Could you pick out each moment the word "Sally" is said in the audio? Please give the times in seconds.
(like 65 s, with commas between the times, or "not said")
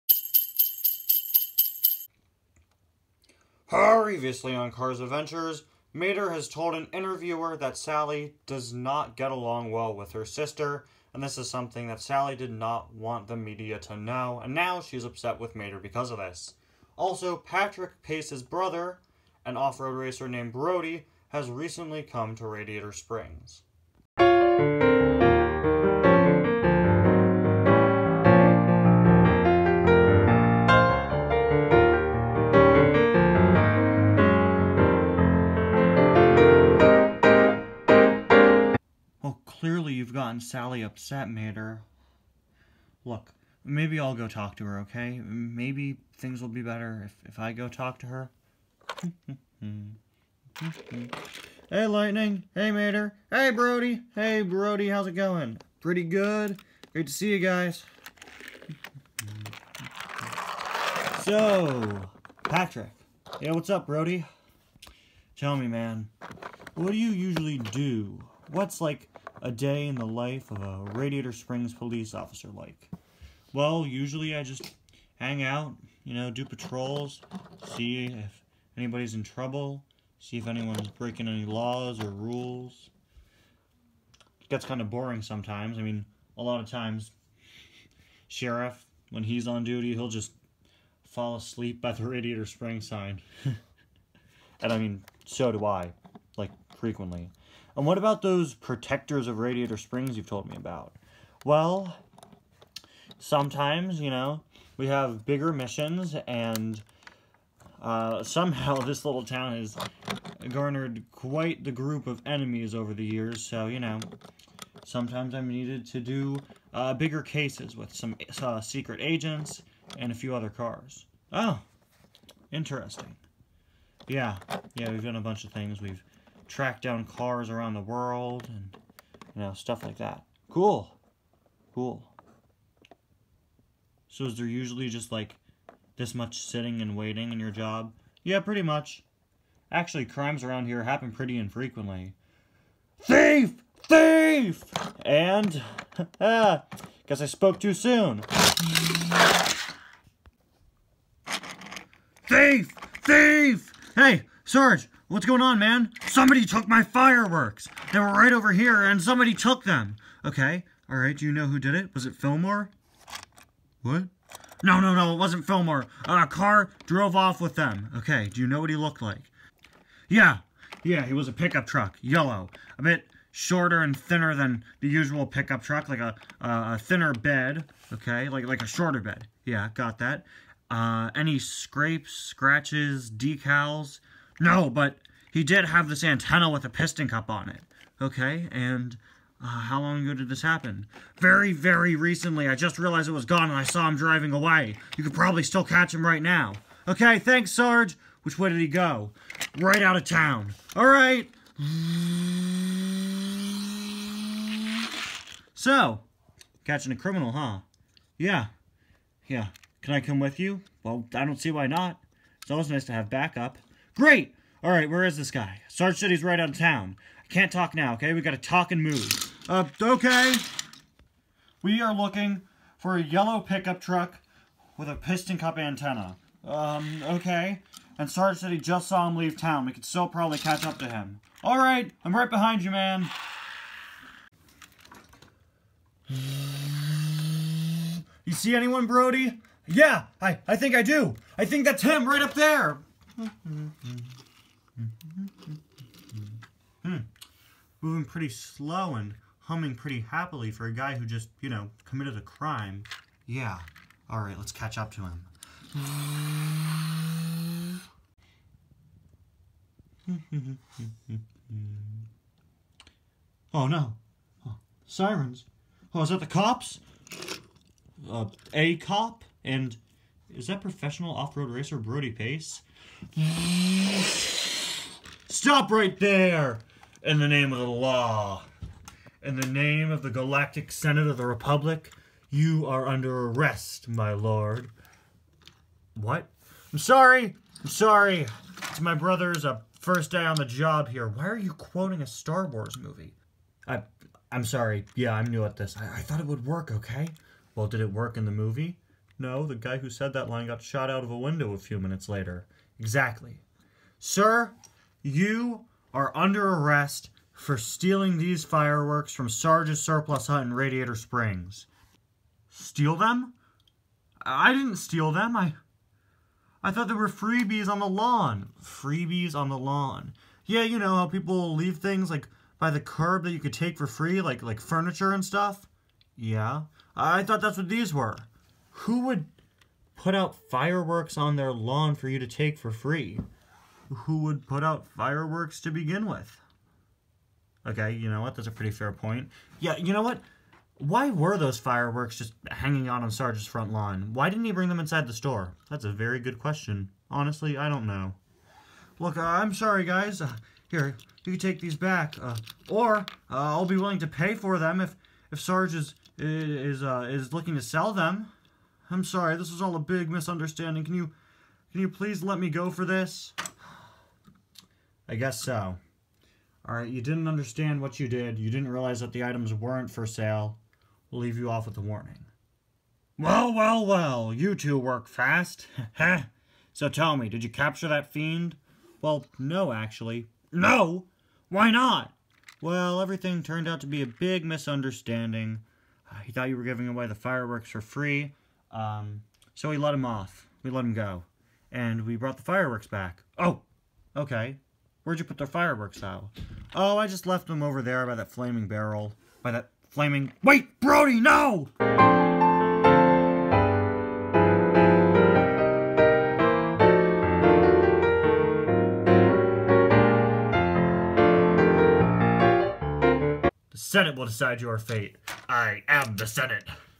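7 s, 12 s, 40 s.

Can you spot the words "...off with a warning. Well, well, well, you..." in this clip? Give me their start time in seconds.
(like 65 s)
371 s.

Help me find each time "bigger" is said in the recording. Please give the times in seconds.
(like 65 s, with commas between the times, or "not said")
105 s, 116 s.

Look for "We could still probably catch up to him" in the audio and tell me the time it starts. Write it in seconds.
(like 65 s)
229 s.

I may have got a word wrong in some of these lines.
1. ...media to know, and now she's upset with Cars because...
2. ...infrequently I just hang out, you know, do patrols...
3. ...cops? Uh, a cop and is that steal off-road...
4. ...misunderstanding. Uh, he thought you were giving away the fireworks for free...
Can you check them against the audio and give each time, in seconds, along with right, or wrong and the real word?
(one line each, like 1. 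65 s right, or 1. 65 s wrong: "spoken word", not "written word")
1. 13 s wrong: "Mater", not "Cars"
2. 73 s wrong: "usually", not "infrequently"
3. 266 s wrong: "professional", not "steal"
4. 384 s right.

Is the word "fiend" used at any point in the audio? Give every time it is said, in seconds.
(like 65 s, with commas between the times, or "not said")
378 s.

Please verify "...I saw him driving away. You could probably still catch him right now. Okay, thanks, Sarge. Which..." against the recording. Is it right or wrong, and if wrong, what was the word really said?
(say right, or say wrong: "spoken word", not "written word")
right.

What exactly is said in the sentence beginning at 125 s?
We've track down cars around the world and you know stuff like that.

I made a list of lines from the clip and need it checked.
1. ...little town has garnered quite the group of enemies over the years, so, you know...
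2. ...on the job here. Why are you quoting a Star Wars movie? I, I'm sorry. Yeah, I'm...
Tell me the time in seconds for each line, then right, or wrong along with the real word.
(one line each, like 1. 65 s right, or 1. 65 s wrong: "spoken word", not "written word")
1. 109 s right
2. 290 s right.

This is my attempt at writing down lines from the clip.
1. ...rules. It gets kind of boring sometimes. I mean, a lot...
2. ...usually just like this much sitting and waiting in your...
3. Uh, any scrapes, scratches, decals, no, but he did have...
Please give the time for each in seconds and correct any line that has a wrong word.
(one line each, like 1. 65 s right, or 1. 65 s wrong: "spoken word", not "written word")
1. 82 s right
2. 134 s right
3. 180 s right.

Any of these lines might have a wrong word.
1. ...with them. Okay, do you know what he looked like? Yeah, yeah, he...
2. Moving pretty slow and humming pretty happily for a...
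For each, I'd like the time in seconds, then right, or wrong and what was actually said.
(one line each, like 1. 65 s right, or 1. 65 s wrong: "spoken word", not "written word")
1. 167 s right
2. 247 s right.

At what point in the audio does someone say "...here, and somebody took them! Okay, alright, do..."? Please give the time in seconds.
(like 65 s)
158 s.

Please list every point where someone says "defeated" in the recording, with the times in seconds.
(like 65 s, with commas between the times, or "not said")
not said.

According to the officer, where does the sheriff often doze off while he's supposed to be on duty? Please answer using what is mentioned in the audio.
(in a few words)
By the Radiator Springs sign.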